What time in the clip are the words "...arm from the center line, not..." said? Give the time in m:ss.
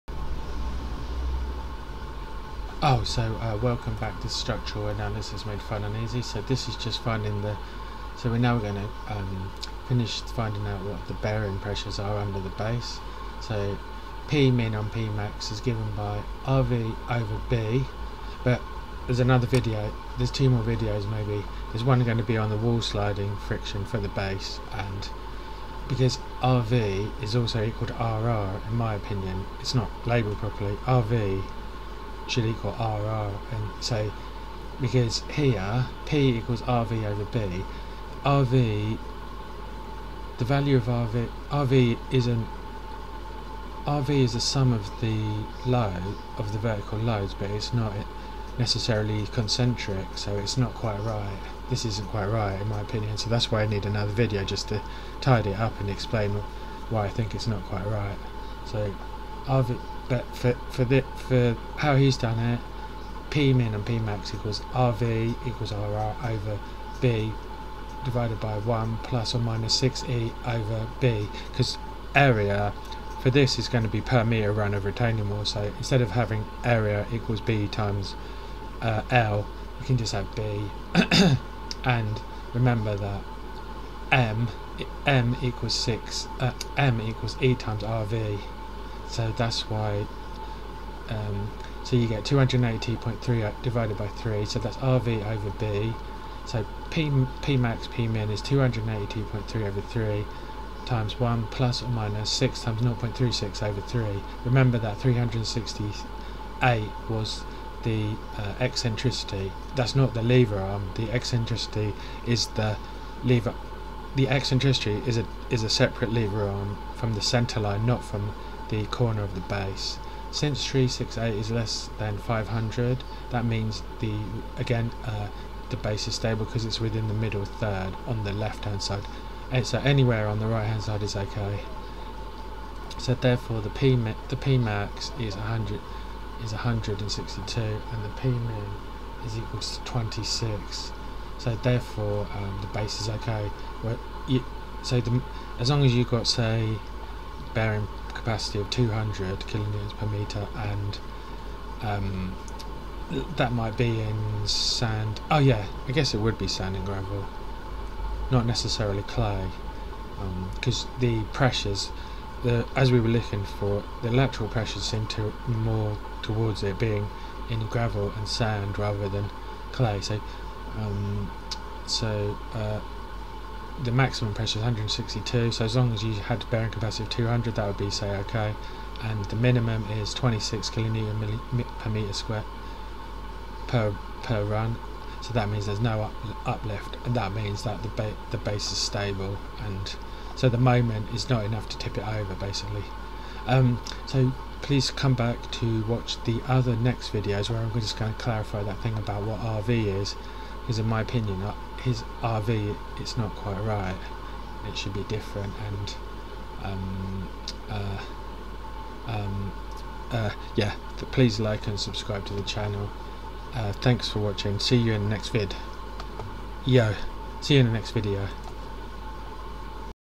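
1:56.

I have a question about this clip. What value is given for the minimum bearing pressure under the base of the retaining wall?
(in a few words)
26.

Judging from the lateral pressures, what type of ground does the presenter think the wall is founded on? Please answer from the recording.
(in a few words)
sand and gravel.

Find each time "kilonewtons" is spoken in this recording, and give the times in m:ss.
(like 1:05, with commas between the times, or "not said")
2:29, 3:00.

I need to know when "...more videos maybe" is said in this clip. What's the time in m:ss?
0:20.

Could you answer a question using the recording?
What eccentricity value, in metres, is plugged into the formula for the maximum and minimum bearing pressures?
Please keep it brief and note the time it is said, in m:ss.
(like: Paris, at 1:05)
0.36, at 1:42.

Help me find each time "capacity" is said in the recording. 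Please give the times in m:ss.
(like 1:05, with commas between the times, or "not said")
2:28, 2:56.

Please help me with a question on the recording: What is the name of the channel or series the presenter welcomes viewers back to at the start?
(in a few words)
Structural Analysis Made Fun and Easy.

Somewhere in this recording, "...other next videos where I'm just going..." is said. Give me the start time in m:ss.
3:16.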